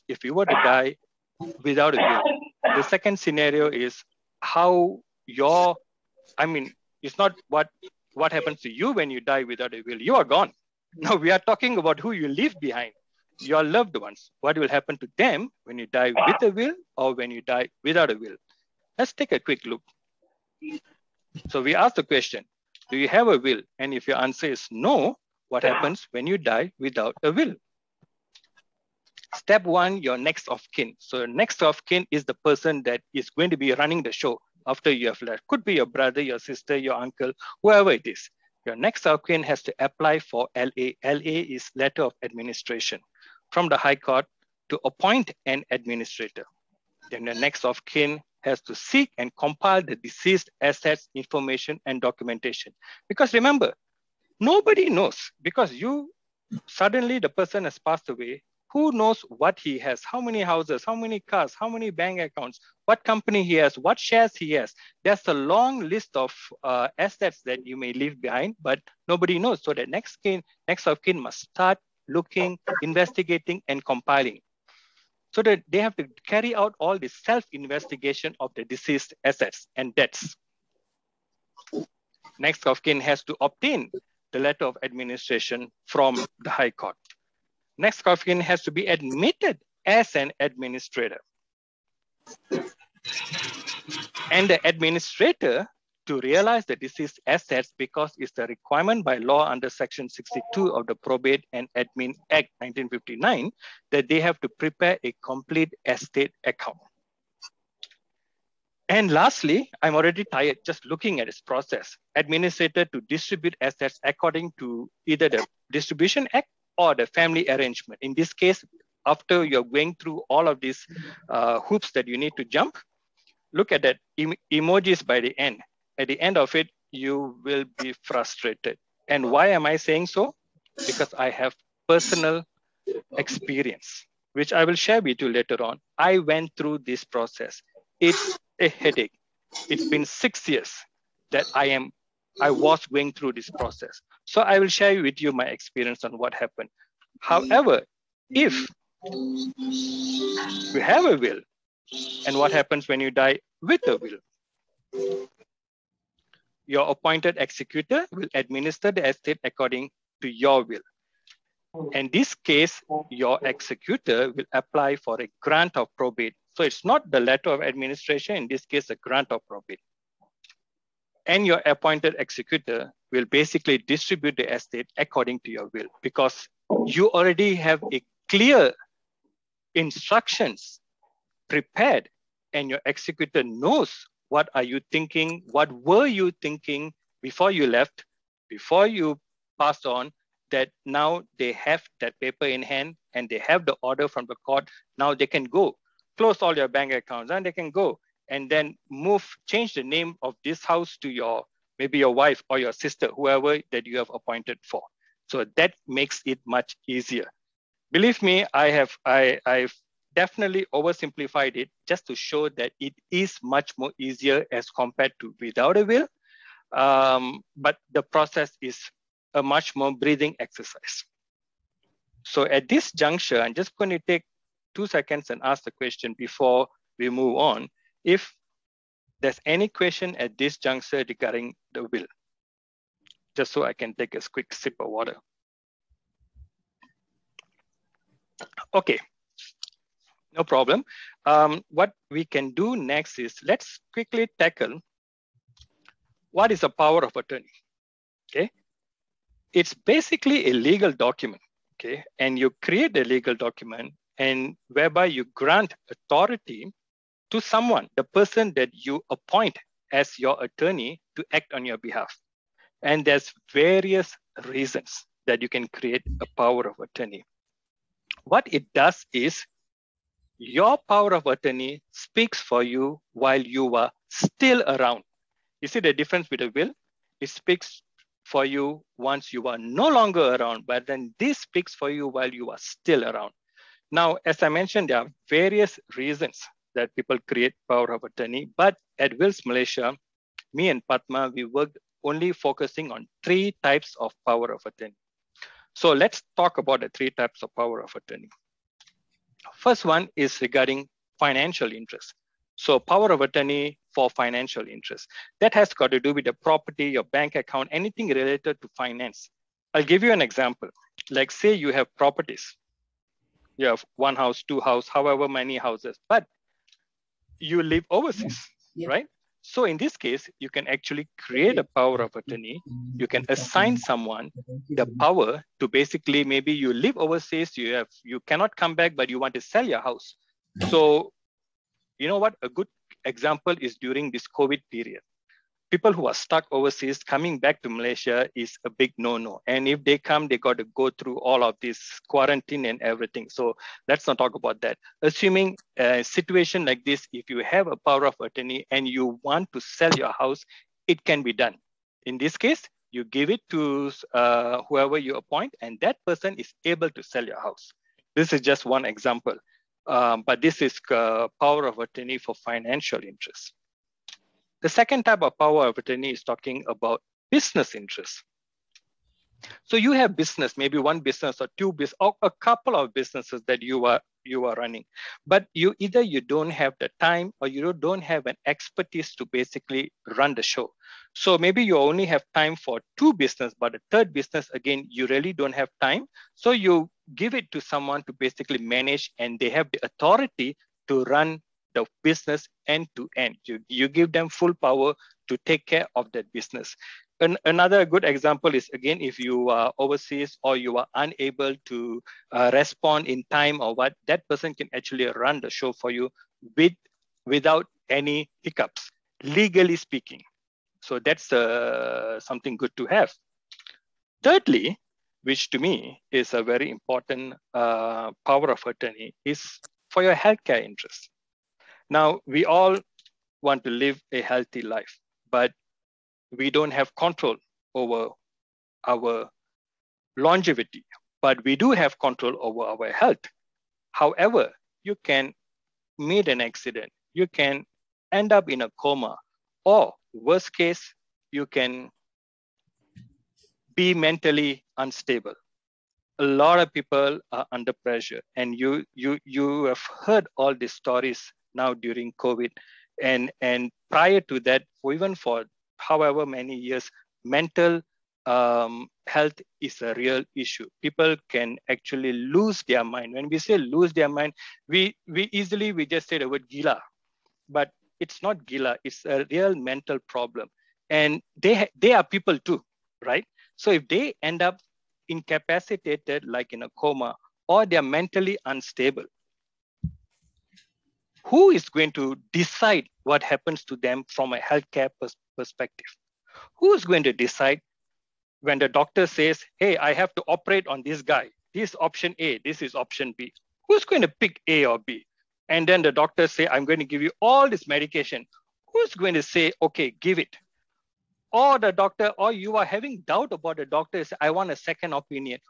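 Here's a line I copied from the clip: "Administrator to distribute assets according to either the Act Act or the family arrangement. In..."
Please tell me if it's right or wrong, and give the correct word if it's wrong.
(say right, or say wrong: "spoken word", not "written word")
wrong: "Distribution", not "Act".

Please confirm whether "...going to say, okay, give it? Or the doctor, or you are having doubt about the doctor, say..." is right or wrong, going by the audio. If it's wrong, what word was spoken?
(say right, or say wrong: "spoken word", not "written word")
right.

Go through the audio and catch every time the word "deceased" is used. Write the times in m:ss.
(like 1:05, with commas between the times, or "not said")
0:49, 1:18, 1:36.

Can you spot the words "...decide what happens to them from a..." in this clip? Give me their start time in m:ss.
8:02.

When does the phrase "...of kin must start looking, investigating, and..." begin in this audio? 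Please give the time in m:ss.
1:10.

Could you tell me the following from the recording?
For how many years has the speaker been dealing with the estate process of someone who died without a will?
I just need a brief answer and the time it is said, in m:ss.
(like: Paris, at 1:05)
6, at 2:20.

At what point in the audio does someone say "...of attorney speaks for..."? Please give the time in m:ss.
4:31.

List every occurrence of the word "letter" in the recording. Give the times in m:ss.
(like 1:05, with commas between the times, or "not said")
0:41, 1:24, 2:47.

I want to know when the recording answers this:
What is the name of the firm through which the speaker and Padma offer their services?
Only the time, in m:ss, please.
4:49.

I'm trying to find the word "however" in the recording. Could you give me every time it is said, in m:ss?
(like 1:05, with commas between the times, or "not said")
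2:27, 5:14, 7:13, 7:35.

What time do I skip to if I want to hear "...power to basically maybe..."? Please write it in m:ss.
5:24.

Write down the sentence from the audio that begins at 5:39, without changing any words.
And if they come, they got to go through all of this quarantine and everything.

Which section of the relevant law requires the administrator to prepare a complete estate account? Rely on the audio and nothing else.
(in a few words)
Section 62.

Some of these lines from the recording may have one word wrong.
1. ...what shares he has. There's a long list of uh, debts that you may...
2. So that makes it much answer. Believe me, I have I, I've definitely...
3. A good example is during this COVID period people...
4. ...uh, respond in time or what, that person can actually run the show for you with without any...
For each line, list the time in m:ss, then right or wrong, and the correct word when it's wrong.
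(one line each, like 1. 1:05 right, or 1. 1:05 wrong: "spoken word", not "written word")
1. 1:03 wrong: "assets", not "debts"
2. 3:25 wrong: "easier", not "answer"
3. 5:32 right
4. 6:42 right.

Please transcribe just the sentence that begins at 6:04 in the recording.
The second type of power of attorney is talking about business interests.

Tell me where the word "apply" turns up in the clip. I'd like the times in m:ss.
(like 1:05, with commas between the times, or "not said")
0:39, 2:44.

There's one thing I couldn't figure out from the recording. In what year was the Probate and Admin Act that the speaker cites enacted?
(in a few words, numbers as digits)
1959.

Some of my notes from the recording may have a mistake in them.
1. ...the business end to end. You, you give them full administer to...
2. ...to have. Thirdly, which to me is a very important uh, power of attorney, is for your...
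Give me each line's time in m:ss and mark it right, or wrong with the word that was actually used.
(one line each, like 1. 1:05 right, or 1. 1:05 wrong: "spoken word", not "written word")
1. 6:31 wrong: "power", not "administer"
2. 6:52 right.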